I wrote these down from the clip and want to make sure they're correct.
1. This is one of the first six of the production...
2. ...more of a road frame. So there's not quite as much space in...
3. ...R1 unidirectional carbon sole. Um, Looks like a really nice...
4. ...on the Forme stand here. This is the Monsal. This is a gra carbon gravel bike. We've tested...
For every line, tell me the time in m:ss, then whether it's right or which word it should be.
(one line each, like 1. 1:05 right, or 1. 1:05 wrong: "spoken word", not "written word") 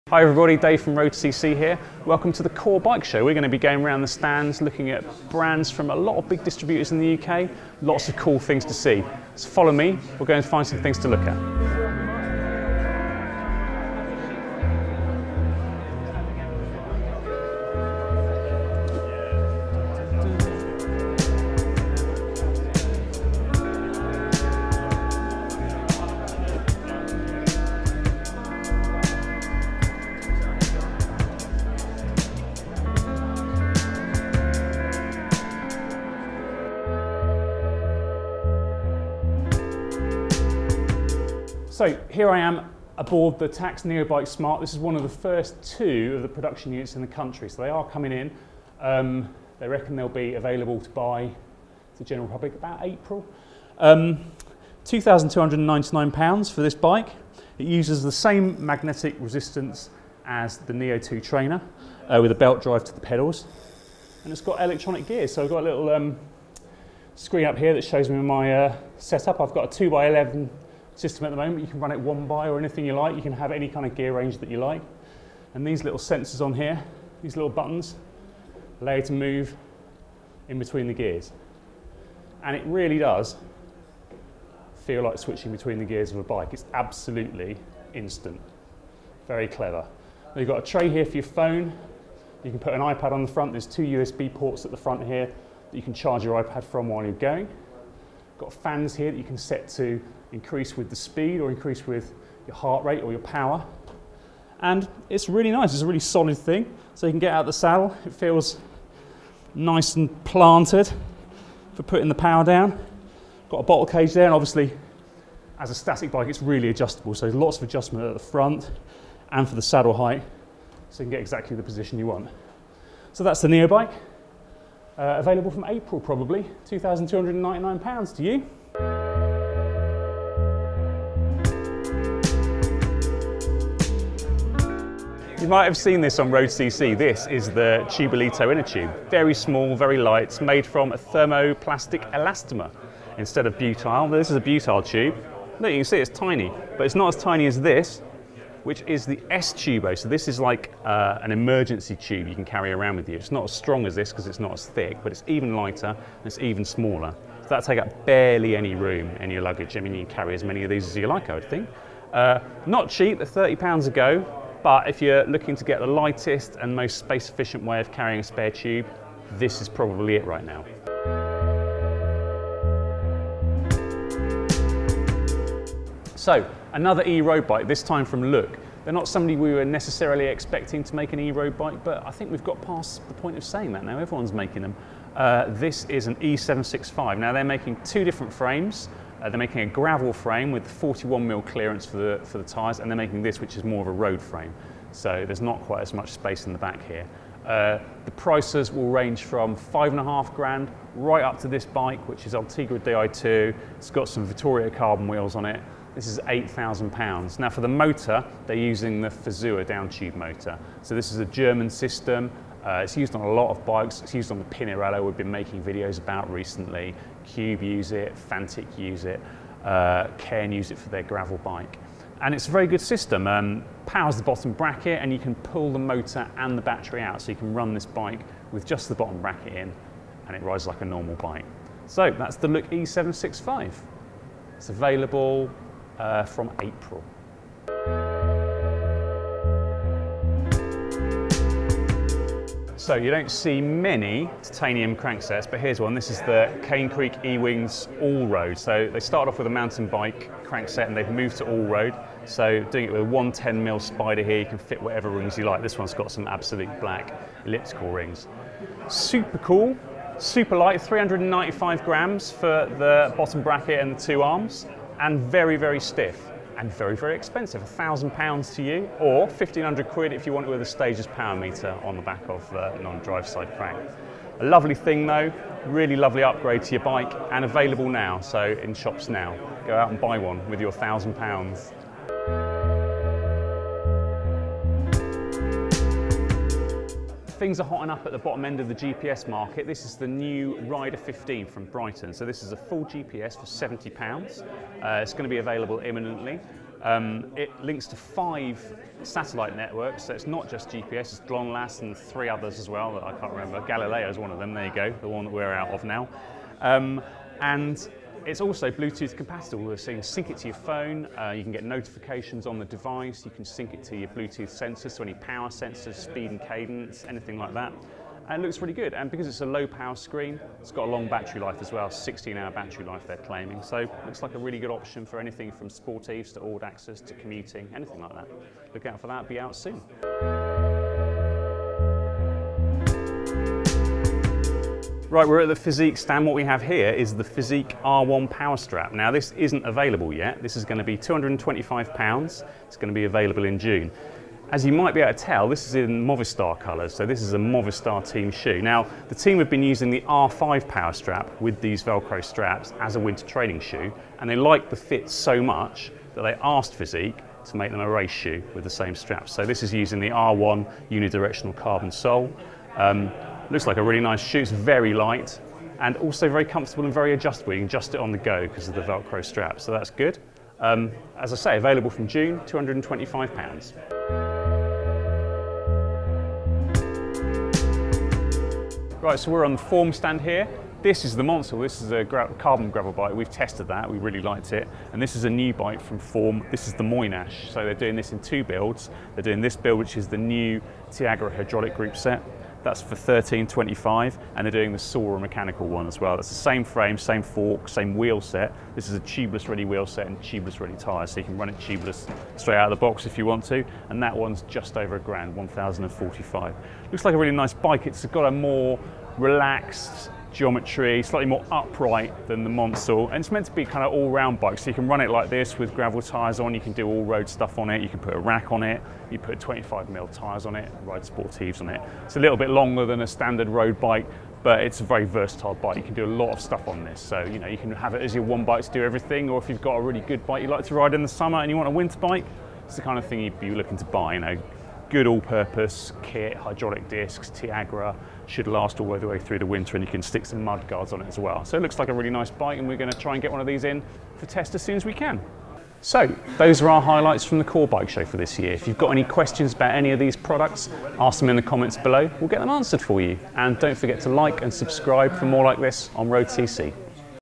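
1. 0:44 wrong: "two", not "six"
2. 3:13 right
3. 6:00 right
4. 6:19 right.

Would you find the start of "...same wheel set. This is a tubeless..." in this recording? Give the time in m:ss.
6:37.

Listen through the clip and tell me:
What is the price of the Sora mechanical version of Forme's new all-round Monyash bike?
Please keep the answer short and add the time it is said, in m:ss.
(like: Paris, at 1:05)
£1,045, at 6:45.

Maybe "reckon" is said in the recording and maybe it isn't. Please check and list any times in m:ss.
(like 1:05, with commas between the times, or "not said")
0:49.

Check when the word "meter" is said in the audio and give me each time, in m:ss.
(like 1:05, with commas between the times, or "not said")
4:31.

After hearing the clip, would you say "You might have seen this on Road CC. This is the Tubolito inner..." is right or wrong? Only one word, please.
right.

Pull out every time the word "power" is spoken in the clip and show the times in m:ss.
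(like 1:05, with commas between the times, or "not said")
1:43, 1:52, 3:43, 4:31, 5:15, 5:19, 5:38, 5:50.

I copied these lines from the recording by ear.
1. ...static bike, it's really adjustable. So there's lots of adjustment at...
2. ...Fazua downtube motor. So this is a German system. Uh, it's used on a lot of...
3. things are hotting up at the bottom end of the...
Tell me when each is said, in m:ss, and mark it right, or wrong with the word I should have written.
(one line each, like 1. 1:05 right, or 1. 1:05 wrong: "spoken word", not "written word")
1. 1:55 right
2. 3:29 right
3. 4:47 right.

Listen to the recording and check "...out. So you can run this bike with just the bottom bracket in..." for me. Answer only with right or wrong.
right.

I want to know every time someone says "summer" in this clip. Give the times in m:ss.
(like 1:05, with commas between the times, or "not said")
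7:11.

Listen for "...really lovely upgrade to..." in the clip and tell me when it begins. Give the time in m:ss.
4:35.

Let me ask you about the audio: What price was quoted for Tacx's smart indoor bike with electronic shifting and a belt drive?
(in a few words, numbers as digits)
£2,299.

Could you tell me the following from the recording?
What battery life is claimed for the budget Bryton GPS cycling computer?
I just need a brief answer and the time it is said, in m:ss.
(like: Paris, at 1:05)
16 hours, at 5:21.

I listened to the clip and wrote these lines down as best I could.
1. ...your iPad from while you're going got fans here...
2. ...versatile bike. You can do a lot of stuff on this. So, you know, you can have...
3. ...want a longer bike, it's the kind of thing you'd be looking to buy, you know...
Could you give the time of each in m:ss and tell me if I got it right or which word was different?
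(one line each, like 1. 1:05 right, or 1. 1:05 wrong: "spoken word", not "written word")
1. 1:36 right
2. 7:05 right
3. 7:11 wrong: "winter", not "longer".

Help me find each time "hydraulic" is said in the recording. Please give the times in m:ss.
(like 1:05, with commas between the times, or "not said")
6:31, 7:16.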